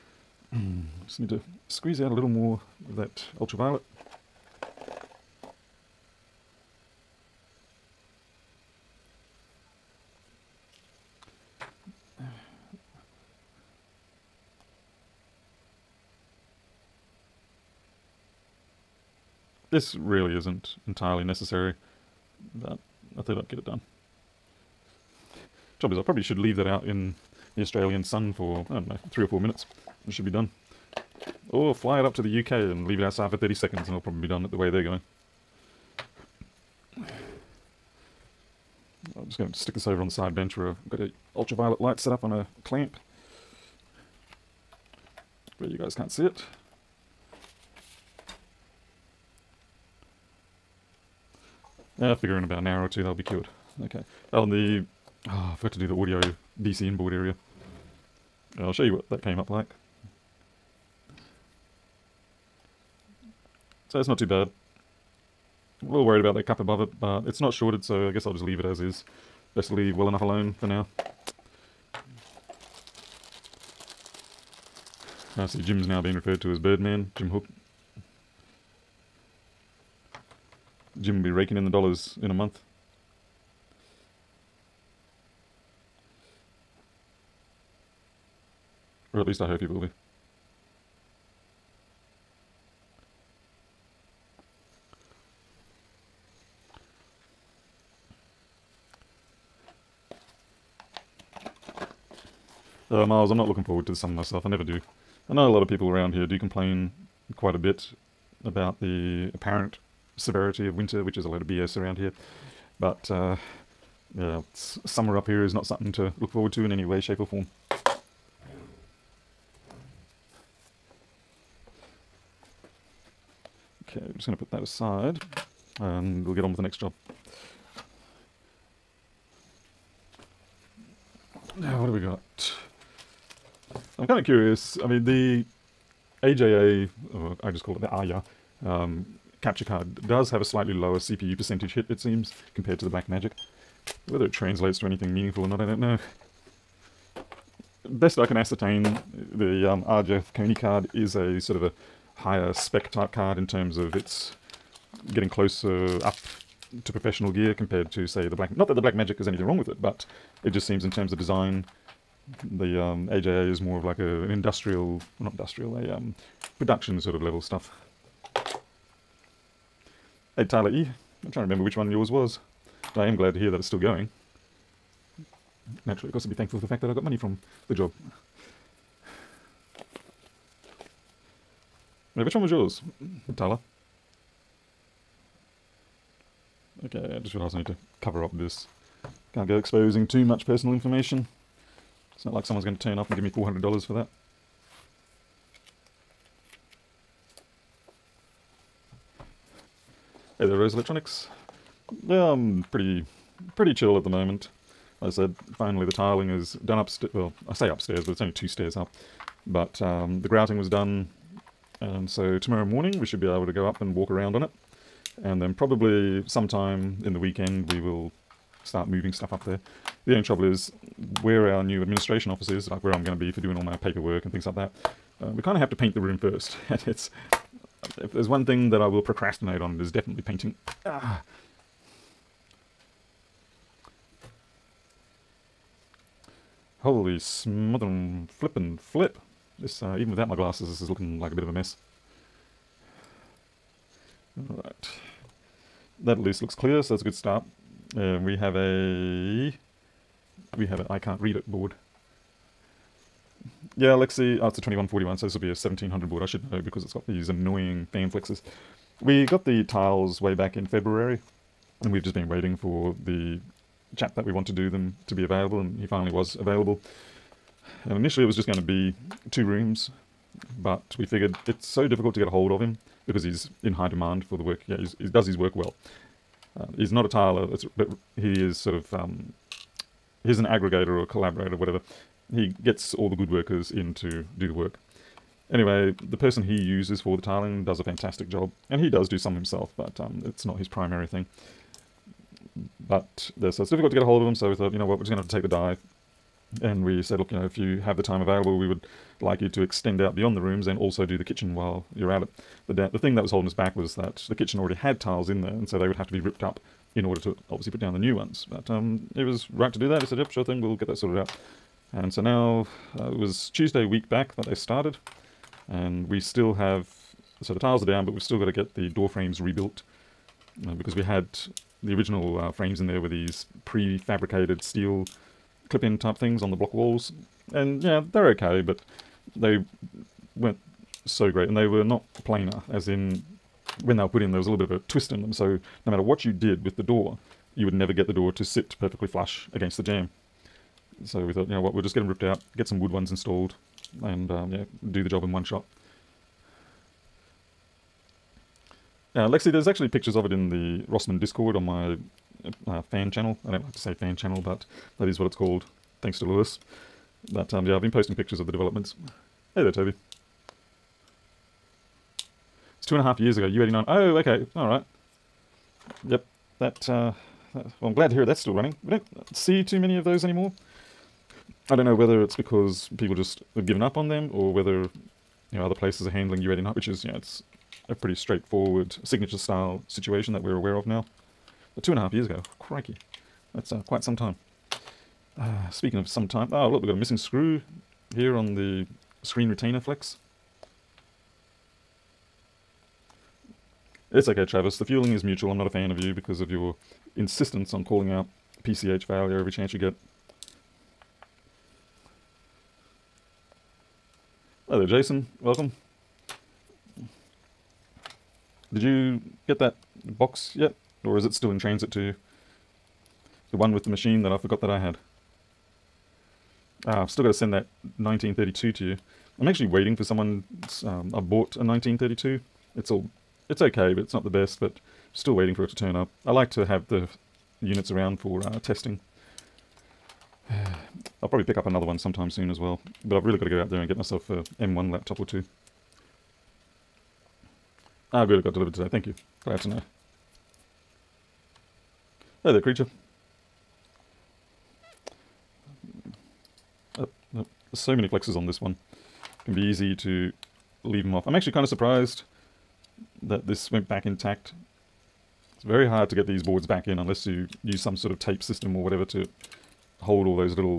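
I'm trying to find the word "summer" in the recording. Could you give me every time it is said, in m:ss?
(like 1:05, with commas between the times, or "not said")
1:43, 1:54.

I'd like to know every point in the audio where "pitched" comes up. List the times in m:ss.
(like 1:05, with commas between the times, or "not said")
not said.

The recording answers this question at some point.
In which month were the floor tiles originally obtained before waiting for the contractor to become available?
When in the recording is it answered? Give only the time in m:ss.
4:20.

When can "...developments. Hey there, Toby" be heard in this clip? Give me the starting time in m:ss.
5:58.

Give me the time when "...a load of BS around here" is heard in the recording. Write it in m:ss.
1:51.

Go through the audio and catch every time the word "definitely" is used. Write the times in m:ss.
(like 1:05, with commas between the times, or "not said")
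3:49.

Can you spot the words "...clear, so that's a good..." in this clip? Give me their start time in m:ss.
4:06.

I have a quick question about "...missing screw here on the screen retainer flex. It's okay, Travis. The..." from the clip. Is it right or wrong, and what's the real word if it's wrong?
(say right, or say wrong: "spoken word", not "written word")
right.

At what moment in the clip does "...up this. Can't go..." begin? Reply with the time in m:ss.
3:08.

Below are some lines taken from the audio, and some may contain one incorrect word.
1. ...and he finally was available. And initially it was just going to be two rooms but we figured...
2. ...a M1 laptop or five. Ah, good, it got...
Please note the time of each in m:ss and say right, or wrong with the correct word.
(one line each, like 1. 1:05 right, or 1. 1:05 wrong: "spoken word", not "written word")
1. 4:25 right
2. 7:14 wrong: "two", not "five".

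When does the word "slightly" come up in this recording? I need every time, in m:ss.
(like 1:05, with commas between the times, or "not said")
2:20.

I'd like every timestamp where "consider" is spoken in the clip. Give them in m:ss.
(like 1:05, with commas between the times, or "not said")
not said.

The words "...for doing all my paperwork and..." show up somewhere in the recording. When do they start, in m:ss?
3:43.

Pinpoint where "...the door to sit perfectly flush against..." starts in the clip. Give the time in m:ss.
5:38.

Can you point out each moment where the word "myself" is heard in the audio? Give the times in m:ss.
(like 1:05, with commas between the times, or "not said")
1:44, 7:13.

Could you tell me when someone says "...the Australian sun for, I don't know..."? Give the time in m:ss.
0:27.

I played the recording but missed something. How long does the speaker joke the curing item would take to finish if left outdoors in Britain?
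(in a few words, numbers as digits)
30 seconds.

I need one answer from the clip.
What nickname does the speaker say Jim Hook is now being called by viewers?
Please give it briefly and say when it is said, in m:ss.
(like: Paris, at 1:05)
Birdman, at 1:16.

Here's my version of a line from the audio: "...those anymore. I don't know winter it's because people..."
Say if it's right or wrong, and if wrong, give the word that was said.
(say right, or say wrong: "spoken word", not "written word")
wrong: "whether", not "winter".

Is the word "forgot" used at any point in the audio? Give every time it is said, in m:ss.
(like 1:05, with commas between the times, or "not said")
0:55, 6:54.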